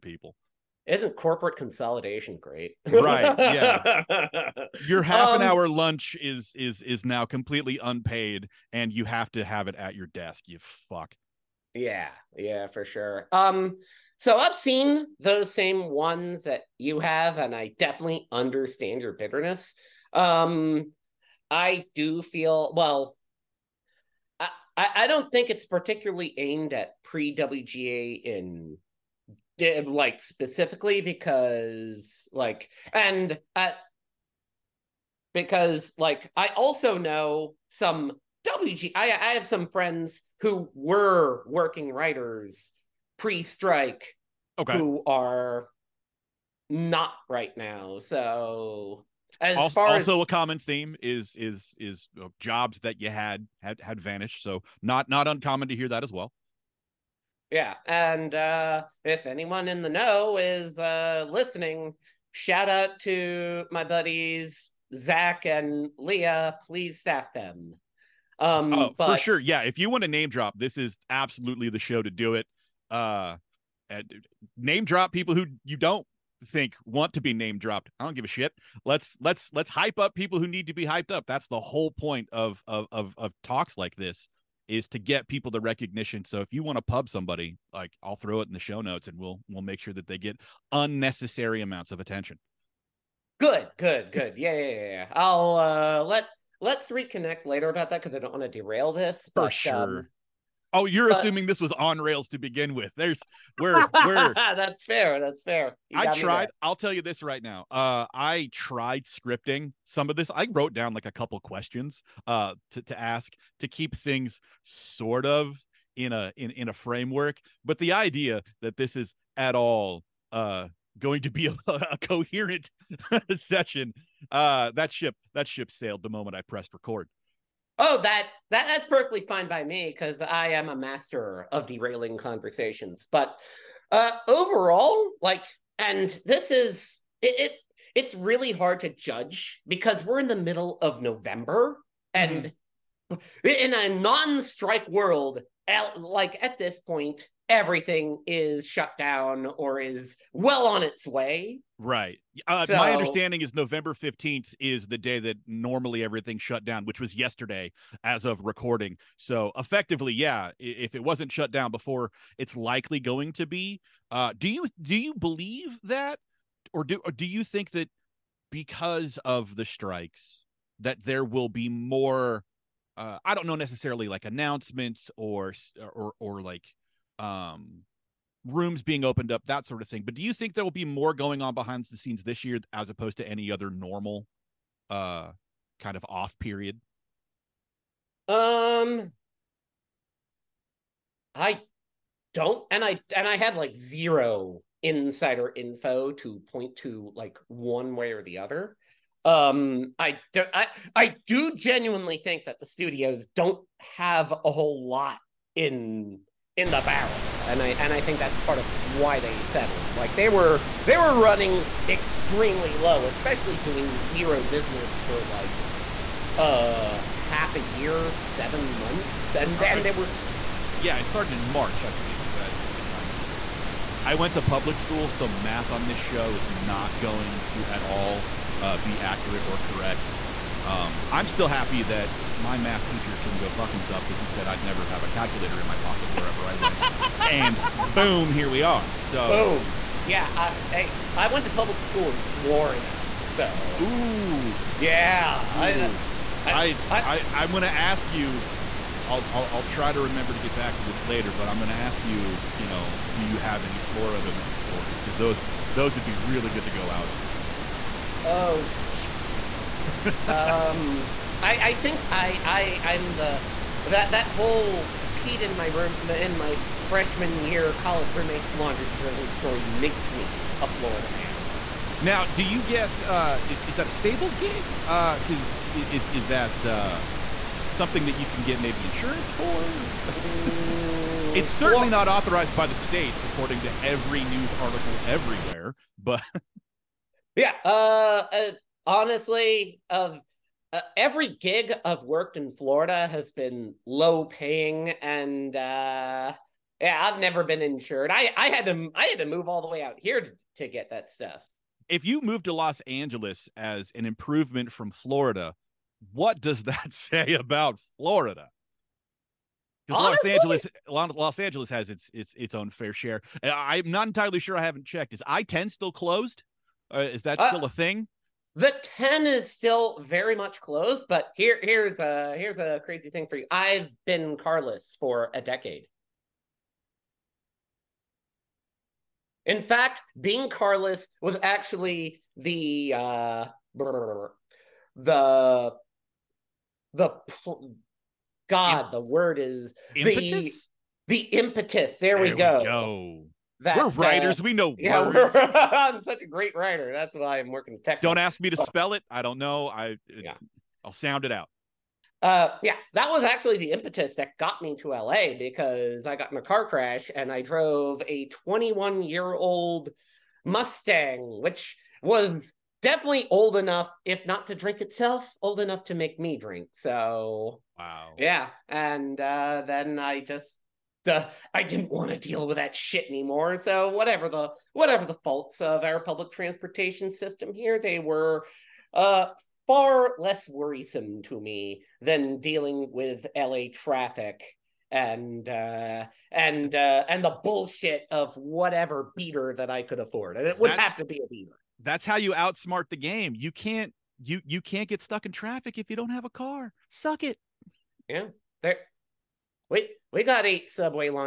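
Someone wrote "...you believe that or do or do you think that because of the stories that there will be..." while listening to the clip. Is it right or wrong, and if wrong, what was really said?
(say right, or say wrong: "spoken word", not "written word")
wrong: "strikes", not "stories".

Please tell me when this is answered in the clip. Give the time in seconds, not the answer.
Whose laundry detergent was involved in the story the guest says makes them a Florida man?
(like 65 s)
266 s.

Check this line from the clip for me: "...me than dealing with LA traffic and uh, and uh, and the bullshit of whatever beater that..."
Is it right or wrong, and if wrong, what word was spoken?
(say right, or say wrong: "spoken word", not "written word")
right.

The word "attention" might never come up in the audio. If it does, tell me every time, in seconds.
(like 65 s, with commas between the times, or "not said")
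91 s.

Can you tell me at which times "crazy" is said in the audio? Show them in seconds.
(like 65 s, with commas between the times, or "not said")
322 s.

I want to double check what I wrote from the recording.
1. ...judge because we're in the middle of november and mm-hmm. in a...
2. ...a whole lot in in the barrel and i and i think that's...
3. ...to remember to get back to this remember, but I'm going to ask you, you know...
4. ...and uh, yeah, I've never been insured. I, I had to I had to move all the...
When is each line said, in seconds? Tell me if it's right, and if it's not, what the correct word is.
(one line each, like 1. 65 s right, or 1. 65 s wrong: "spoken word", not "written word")
1. 138 s right
2. 204 s right
3. 249 s wrong: "later", not "remember"
4. 295 s right.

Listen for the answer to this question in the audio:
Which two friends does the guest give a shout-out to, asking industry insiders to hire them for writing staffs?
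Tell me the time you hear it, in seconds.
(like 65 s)
64 s.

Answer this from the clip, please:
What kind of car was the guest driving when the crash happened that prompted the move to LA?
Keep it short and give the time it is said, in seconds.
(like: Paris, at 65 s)
Mustang, at 360 s.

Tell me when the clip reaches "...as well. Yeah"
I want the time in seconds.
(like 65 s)
56 s.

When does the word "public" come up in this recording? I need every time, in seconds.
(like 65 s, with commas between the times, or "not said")
224 s, 241 s, 375 s.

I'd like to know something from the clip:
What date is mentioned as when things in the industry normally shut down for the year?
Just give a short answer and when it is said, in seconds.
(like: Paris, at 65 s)
November 15th, at 153 s.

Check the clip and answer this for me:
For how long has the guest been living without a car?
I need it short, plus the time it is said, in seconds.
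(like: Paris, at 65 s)
a decade, at 325 s.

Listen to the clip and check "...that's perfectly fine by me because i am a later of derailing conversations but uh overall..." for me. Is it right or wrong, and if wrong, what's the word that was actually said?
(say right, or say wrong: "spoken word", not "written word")
wrong: "master", not "later".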